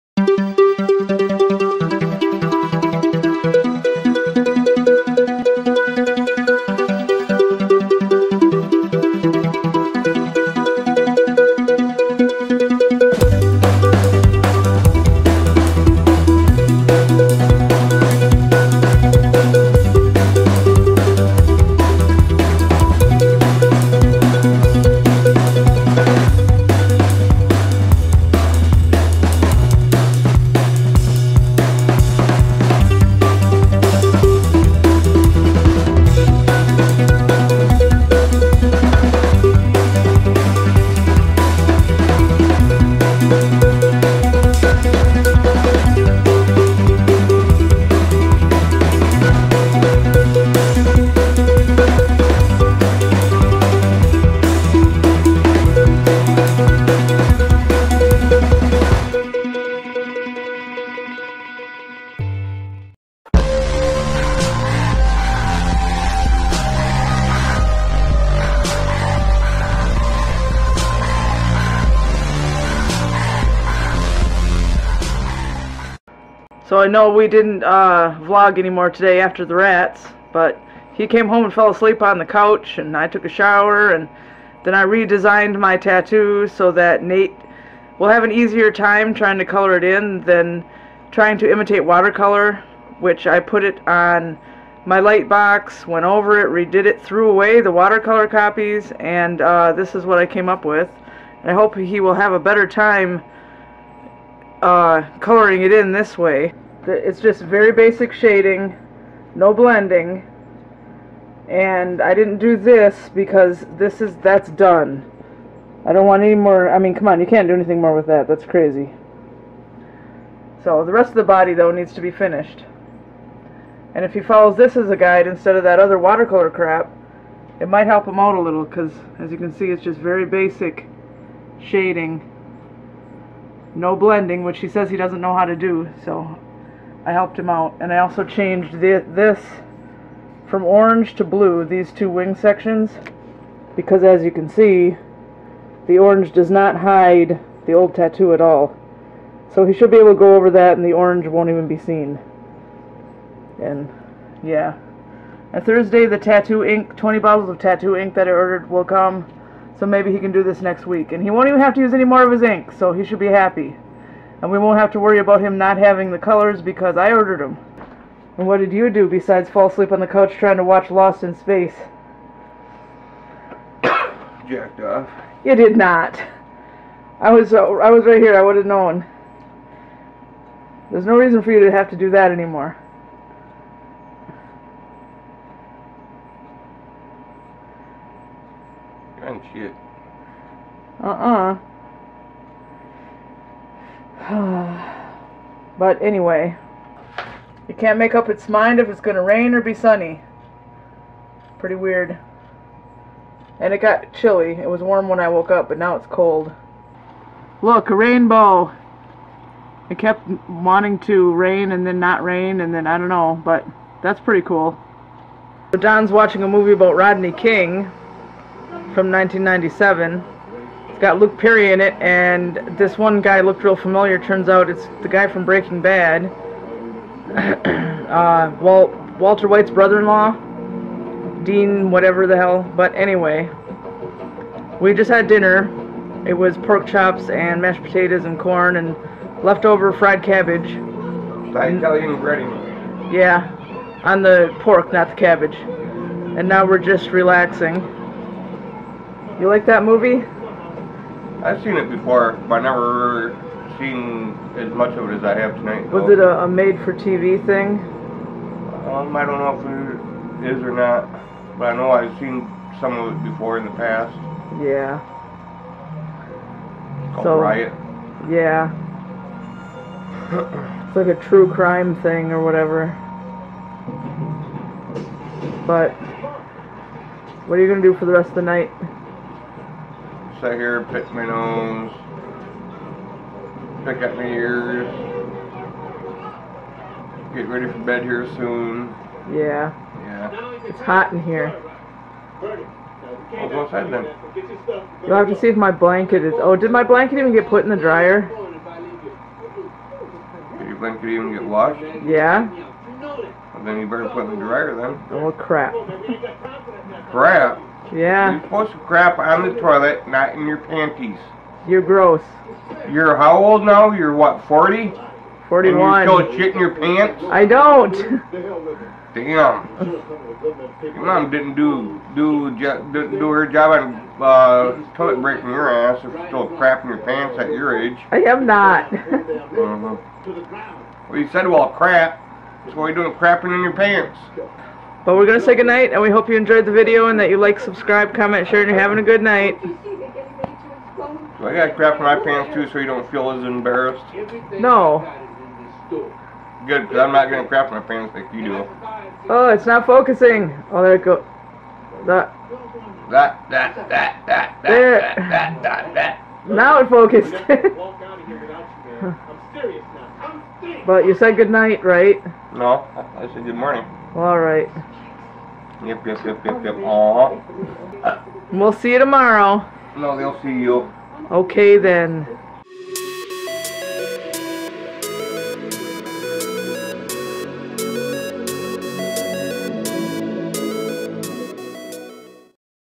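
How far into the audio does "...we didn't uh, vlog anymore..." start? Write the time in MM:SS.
01:17.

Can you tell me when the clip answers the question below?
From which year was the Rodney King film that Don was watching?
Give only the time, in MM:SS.
03:39.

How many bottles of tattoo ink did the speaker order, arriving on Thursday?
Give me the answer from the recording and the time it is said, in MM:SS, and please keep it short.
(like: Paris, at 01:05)
20, at 02:36.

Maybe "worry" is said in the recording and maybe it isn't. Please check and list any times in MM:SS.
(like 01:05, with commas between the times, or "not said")
02:44.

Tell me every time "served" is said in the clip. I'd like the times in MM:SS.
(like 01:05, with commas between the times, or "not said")
not said.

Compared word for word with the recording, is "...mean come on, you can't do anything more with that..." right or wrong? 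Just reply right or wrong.
right.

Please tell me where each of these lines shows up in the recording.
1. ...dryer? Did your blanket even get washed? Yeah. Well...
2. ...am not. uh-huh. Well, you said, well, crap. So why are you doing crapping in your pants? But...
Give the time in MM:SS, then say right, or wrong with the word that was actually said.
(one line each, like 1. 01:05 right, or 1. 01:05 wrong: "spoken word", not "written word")
1. 04:57 right
2. 05:28 right.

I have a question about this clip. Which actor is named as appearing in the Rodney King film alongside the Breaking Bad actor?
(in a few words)
Luke Perry.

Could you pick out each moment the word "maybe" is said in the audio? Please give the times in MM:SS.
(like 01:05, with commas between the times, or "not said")
02:39.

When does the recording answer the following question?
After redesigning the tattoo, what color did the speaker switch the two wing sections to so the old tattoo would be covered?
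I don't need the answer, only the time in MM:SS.
02:21.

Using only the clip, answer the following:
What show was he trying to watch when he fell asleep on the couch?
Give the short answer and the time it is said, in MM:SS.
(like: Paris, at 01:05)
Lost in Space, at 02:50.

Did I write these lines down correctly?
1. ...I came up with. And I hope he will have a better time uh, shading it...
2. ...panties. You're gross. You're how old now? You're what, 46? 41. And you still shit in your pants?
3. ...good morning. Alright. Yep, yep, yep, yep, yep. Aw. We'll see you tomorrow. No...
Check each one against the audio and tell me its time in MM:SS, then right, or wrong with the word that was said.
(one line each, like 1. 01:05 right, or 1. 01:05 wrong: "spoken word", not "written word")
1. 01:40 wrong: "coloring", not "shading"
2. 05:10 wrong: "40", not "46"
3. 06:03 right.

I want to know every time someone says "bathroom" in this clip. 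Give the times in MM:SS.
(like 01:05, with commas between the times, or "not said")
not said.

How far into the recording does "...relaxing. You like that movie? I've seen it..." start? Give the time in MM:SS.
04:07.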